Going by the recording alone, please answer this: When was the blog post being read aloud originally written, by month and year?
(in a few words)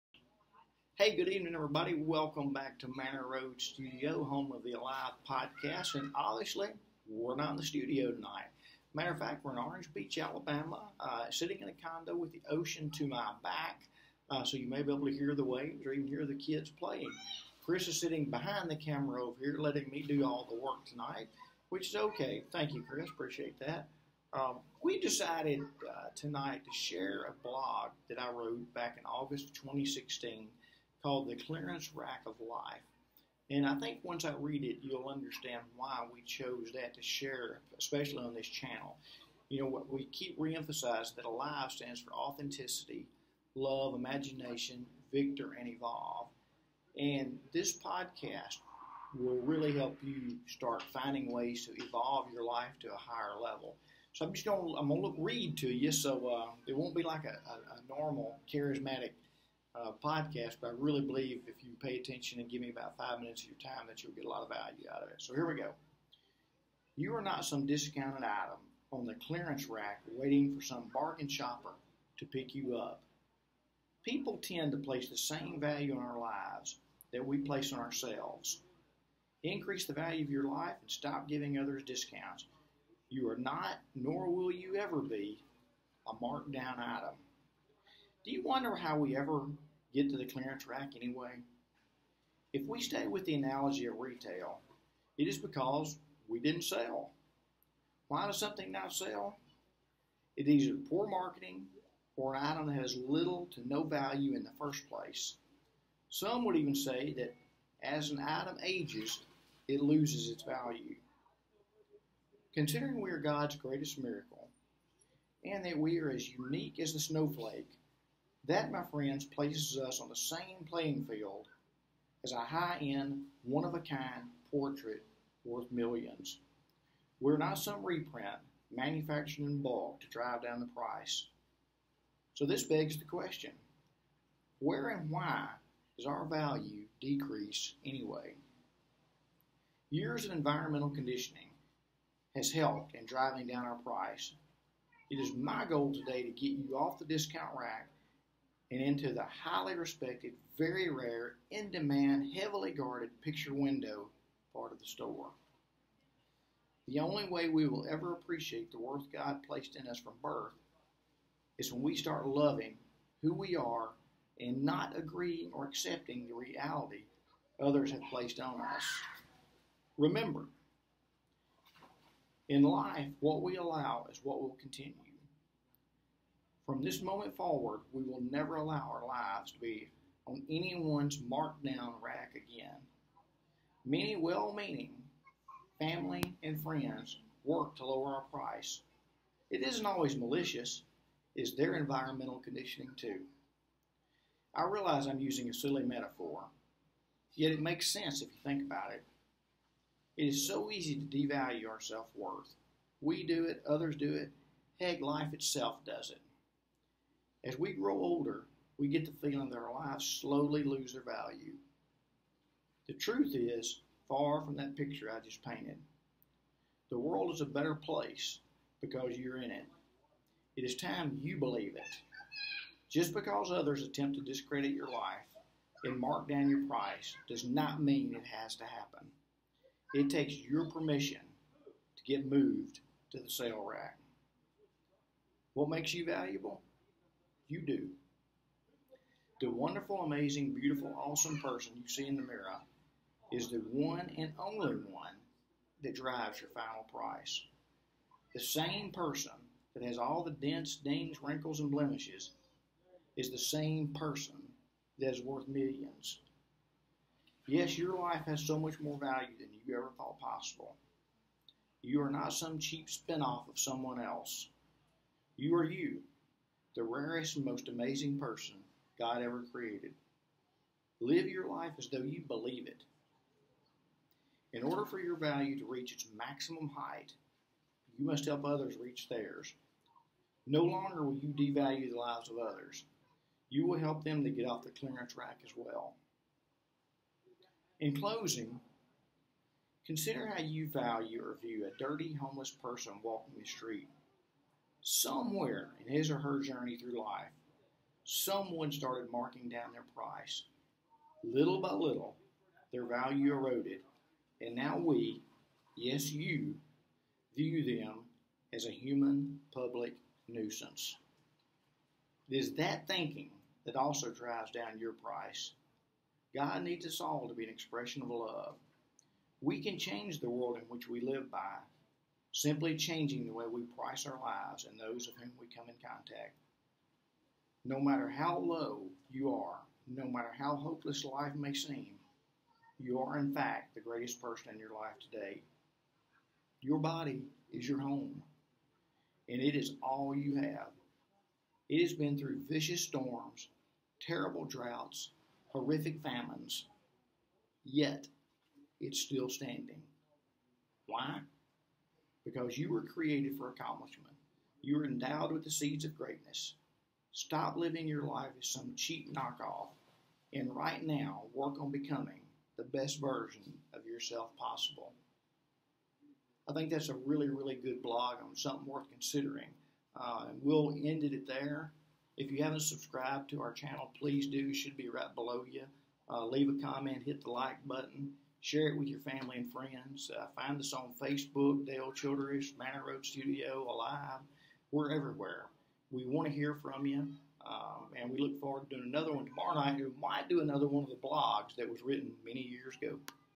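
August 2016.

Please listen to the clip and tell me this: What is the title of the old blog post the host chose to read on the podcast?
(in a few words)
The Clearance Rack of Life.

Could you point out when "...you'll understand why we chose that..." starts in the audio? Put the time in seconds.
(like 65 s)
34 s.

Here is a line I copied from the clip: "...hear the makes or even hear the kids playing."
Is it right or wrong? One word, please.
wrong.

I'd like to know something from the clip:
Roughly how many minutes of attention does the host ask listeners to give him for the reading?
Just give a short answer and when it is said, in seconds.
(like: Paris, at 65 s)
5, at 62 s.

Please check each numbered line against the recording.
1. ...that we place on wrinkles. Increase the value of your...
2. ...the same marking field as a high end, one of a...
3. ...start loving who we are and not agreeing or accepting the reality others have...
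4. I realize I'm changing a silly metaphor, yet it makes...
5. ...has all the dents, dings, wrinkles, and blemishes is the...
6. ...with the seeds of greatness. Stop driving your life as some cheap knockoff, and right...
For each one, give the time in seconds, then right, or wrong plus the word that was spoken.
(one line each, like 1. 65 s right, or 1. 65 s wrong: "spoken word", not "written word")
1. 77 s wrong: "ourselves", not "wrinkles"
2. 120 s wrong: "playing", not "marking"
3. 161 s right
4. 194 s wrong: "using", not "changing"
5. 249 s right
6. 355 s wrong: "living", not "driving".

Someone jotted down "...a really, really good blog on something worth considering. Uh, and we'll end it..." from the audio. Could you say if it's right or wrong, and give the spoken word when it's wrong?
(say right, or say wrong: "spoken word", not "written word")
right.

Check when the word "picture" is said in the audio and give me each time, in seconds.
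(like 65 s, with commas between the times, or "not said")
153 s, 214 s.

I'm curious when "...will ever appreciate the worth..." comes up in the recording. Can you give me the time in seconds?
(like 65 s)
157 s.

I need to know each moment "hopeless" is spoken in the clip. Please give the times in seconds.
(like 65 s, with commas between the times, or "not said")
330 s.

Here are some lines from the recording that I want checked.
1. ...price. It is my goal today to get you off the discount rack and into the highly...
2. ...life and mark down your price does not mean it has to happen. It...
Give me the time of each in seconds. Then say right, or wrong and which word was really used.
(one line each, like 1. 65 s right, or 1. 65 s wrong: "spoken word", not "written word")
1. 143 s right
2. 224 s right.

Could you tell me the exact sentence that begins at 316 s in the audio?
God needs us all to be an expression of love.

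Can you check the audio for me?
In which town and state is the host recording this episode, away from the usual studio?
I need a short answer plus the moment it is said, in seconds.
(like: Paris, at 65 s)
Orange Beach, Alabama, at 9 s.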